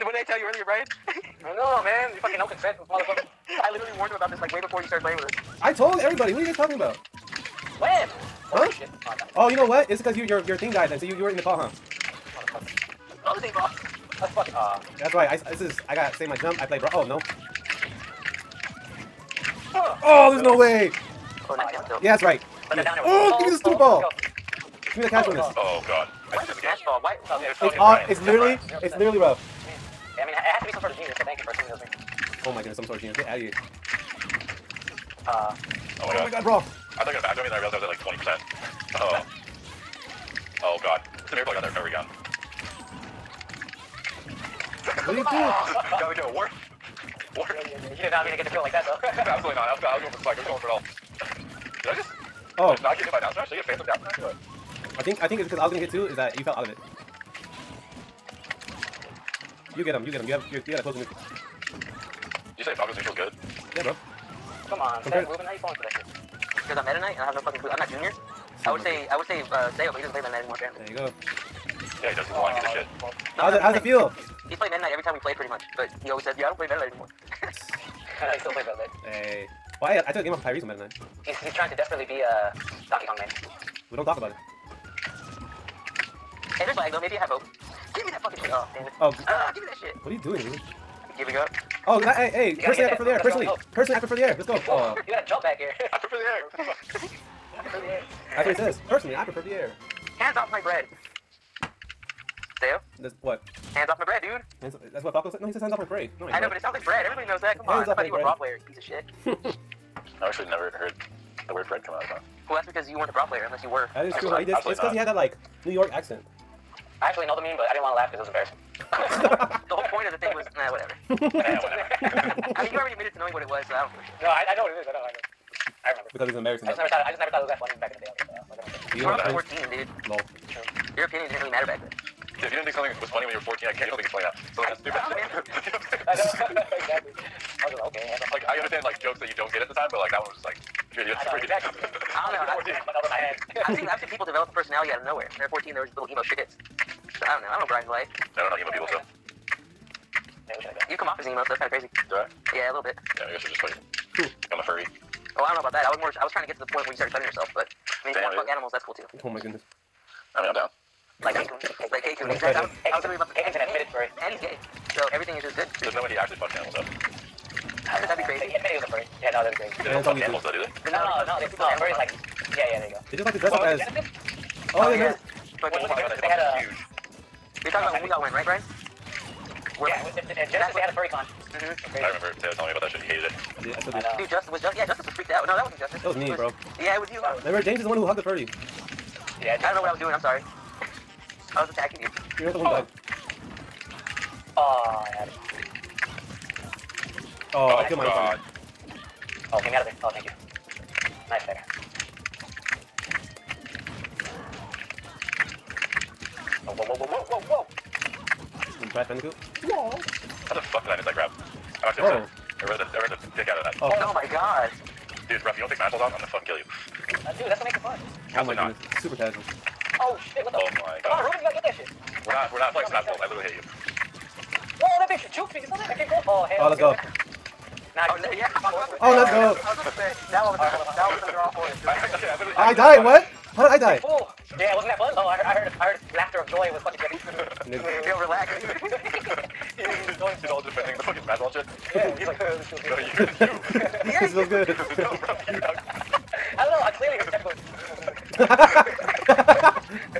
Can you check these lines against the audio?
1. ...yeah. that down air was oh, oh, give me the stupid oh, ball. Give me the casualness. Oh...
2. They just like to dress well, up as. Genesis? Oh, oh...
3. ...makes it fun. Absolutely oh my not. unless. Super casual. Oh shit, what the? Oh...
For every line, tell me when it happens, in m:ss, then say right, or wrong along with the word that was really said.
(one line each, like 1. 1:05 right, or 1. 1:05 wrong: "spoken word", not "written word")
1. 0:22 right
2. 2:53 right
3. 3:37 wrong: "goodness", not "unless".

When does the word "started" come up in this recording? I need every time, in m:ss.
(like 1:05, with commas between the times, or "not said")
0:04, 2:36.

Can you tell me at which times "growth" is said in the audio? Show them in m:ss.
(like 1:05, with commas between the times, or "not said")
not said.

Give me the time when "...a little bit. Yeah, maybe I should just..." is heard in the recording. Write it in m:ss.
2:32.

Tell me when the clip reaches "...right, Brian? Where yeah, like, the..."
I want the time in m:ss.
2:58.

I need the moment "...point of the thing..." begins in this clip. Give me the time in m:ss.
1:59.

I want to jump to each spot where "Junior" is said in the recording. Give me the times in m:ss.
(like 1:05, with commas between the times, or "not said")
1:07.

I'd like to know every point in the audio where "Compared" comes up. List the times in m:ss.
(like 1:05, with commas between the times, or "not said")
1:05.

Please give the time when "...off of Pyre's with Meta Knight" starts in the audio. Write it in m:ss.
1:20.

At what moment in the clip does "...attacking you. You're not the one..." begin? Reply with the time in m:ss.
3:11.